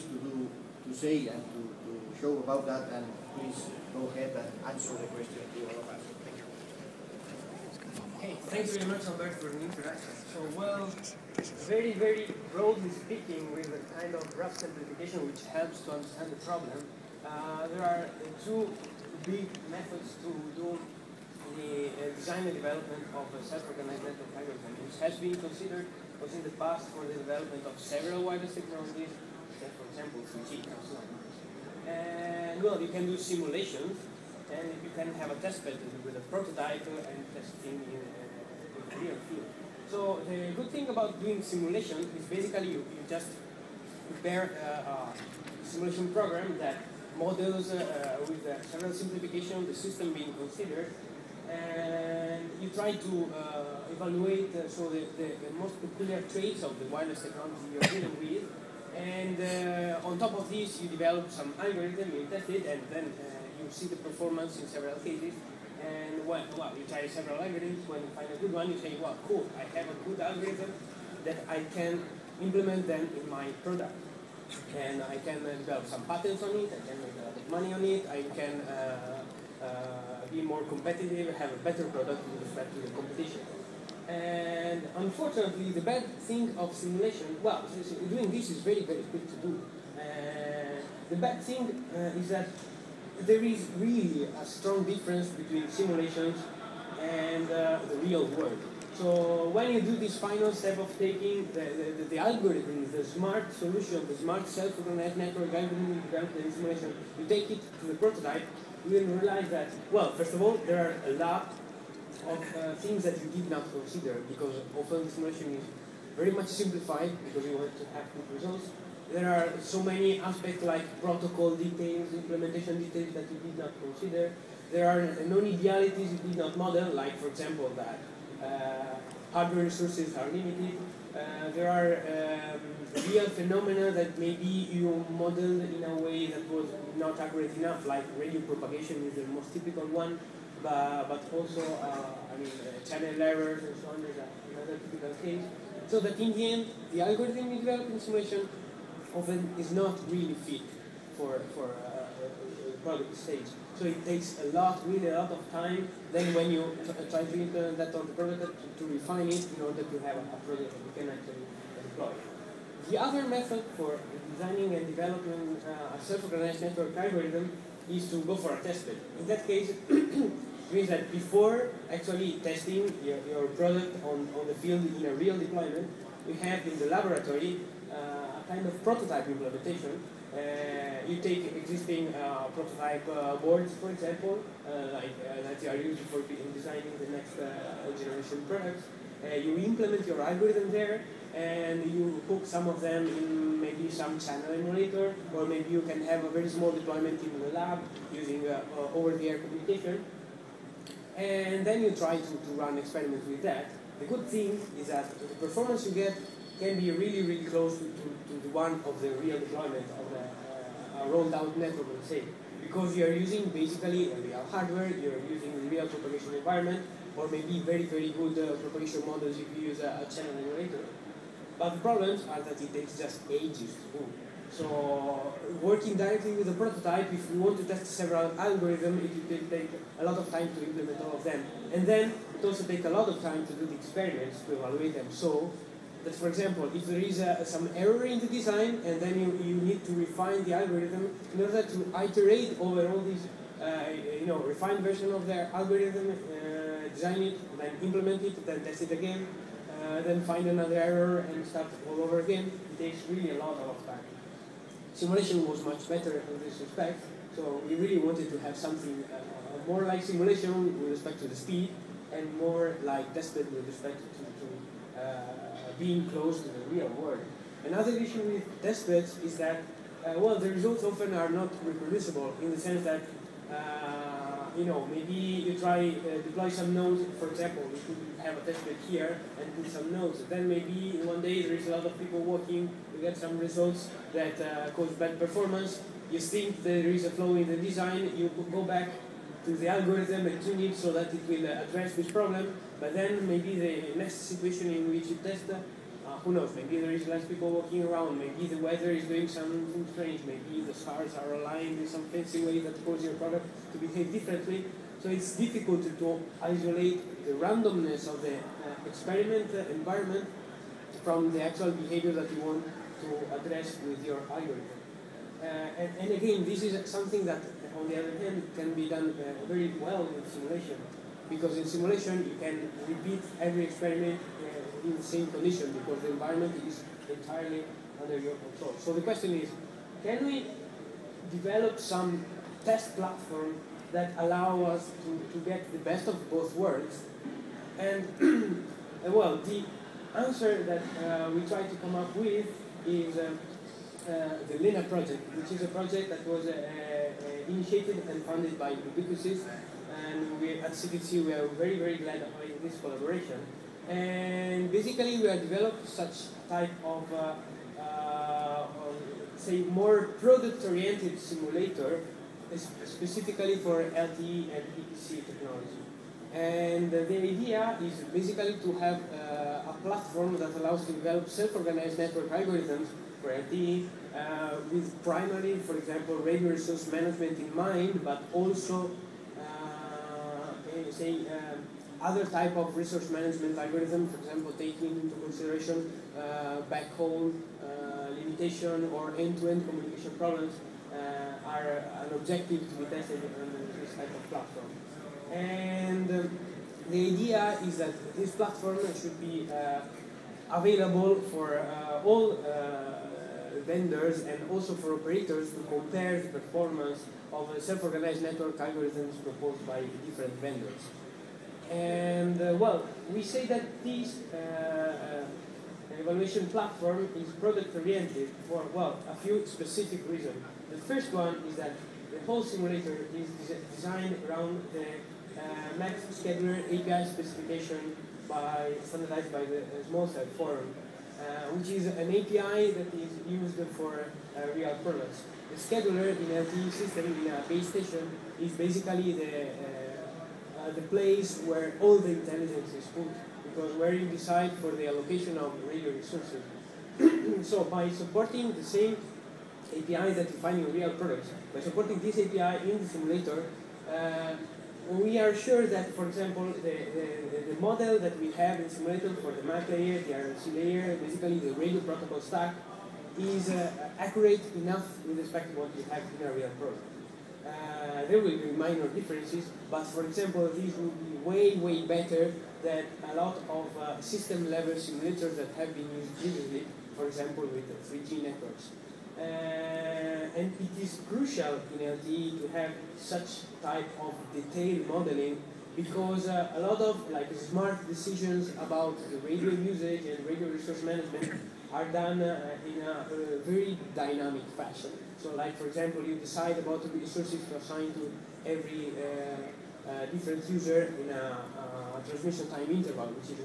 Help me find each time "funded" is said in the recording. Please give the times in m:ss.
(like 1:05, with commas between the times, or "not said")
5:48.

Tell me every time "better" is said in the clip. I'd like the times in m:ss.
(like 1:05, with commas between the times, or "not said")
1:21, 4:15, 7:51.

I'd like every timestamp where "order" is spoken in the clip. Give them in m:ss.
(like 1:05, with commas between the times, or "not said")
2:39, 4:01.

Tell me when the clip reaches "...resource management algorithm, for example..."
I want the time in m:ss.
6:22.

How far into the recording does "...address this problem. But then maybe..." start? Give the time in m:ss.
4:51.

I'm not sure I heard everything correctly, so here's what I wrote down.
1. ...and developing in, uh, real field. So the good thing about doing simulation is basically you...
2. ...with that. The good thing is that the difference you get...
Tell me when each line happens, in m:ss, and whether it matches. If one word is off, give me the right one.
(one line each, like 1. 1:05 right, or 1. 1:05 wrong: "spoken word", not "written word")
1. 0:36 wrong: "testing", not "developing"
2. 3:23 wrong: "performance", not "difference".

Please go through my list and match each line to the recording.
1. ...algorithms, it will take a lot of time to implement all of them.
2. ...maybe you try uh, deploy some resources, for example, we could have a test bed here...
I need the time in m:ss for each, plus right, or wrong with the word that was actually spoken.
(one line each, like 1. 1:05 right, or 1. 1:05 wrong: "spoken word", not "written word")
1. 3:48 right
2. 4:34 wrong: "nodes", not "resources".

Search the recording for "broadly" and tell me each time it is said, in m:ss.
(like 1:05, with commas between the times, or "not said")
0:12.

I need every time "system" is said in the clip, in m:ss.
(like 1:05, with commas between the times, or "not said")
0:49, 7:16, 7:53.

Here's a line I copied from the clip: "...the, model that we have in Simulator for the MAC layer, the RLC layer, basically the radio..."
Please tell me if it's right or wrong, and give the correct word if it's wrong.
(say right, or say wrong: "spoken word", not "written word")
right.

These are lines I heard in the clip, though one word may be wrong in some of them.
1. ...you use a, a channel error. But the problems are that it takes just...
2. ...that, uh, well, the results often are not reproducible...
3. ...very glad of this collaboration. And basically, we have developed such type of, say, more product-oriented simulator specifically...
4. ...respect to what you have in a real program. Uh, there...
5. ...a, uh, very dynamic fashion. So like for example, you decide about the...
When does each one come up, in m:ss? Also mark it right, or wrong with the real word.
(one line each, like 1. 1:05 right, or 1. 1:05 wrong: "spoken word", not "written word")
1. 3:39 wrong: "emulator", not "error"
2. 4:29 right
3. 5:51 right
4. 7:45 right
5. 8:12 right.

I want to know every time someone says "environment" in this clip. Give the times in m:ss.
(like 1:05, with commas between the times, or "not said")
3:36, 5:09, 5:26.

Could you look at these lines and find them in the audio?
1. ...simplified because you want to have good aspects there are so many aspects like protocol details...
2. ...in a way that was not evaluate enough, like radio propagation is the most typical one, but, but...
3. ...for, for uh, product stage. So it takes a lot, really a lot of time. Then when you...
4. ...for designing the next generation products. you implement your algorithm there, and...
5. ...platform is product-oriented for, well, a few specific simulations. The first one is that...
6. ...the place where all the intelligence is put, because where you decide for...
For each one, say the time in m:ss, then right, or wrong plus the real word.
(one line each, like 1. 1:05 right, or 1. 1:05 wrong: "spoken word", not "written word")
1. 1:56 wrong: "results", not "aspects"
2. 2:15 wrong: "accurate", not "evaluate"
3. 2:31 right
4. 3:06 right
5. 6:56 wrong: "reasons", not "simulations"
6. 7:20 right.